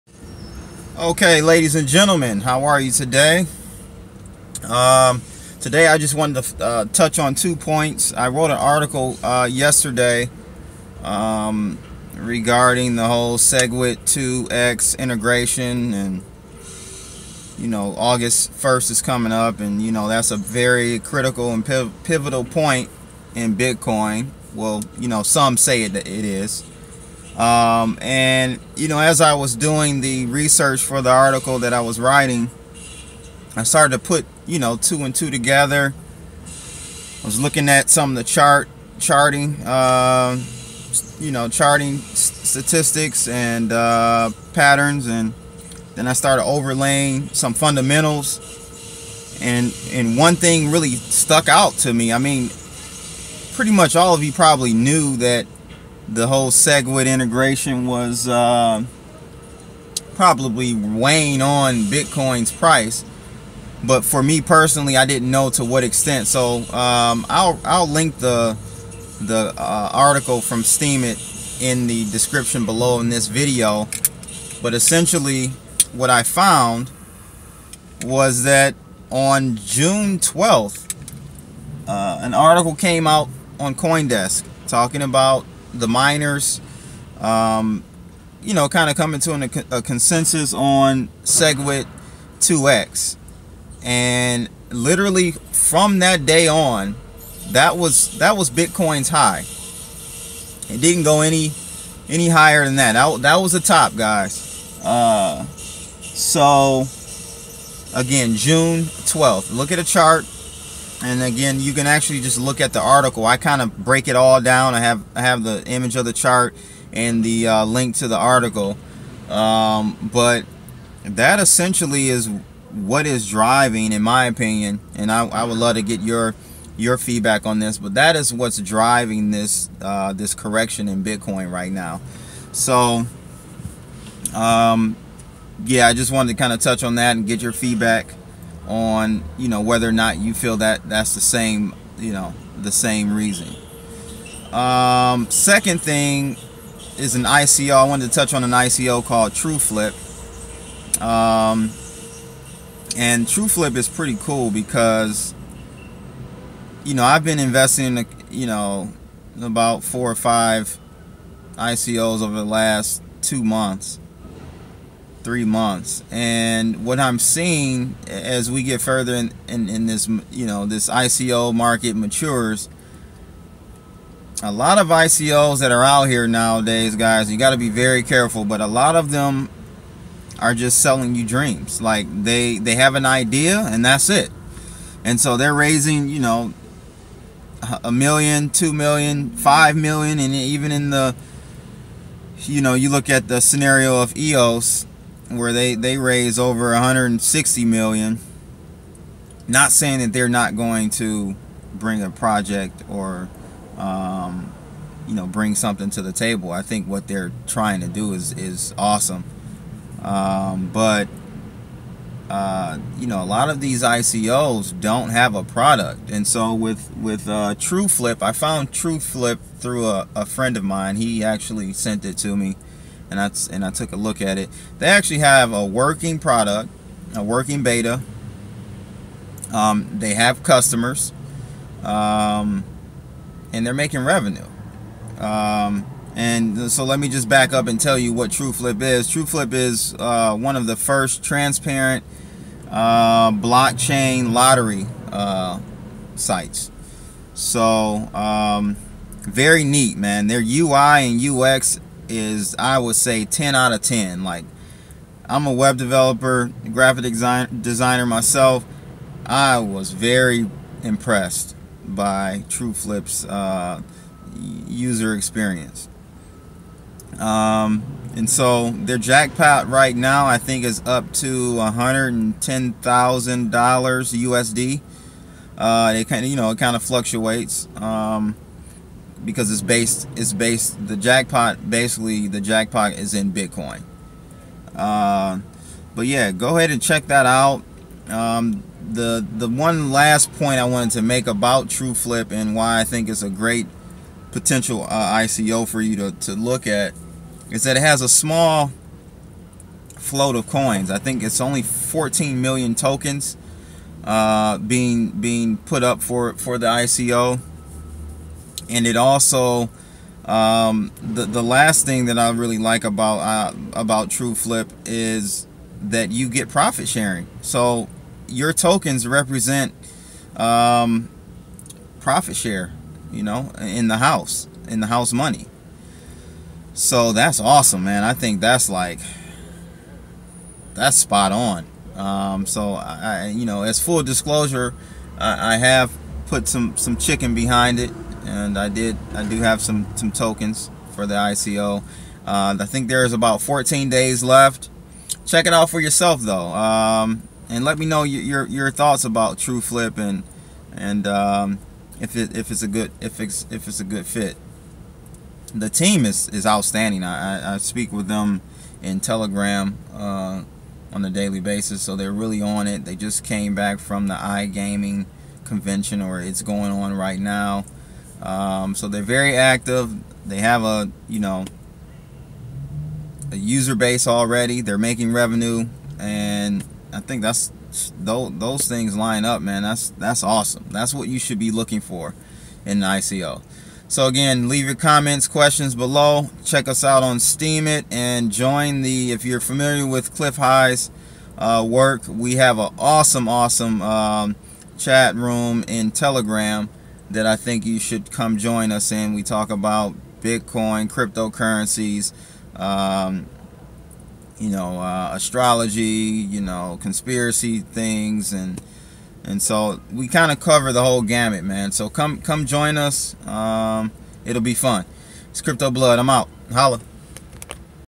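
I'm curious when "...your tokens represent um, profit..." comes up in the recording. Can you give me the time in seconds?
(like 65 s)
318 s.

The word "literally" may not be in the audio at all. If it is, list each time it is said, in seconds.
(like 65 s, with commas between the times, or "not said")
94 s.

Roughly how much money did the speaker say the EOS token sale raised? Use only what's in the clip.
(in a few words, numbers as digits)
over 160 million.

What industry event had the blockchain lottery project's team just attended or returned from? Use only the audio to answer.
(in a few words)
iGaming convention.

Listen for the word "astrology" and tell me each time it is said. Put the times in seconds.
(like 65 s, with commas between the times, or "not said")
405 s.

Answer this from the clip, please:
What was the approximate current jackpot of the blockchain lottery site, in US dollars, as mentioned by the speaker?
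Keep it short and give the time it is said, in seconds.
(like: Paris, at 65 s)
$110,000, at 271 s.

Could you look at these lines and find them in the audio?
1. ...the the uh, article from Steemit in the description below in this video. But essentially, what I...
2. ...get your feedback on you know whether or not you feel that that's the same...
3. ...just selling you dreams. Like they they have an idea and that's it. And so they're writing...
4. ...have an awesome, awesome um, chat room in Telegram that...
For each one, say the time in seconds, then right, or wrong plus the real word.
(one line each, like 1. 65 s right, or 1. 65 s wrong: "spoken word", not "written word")
1. 68 s right
2. 137 s right
3. 180 s wrong: "raising", not "writing"
4. 392 s right.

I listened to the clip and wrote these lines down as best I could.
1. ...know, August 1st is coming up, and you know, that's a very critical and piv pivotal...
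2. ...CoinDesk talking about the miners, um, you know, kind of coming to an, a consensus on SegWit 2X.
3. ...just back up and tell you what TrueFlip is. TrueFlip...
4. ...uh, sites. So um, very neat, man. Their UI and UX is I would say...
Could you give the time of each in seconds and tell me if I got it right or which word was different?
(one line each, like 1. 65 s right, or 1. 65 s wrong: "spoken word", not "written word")
1. 17 s right
2. 83 s right
3. 237 s right
4. 245 s right.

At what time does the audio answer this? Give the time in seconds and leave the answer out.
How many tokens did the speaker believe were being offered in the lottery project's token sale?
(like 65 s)
301 s.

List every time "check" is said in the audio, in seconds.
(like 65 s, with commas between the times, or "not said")
286 s, 345 s, 386 s.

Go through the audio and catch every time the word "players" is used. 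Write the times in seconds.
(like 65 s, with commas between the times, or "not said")
not said.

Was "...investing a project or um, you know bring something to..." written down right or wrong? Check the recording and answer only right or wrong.
wrong.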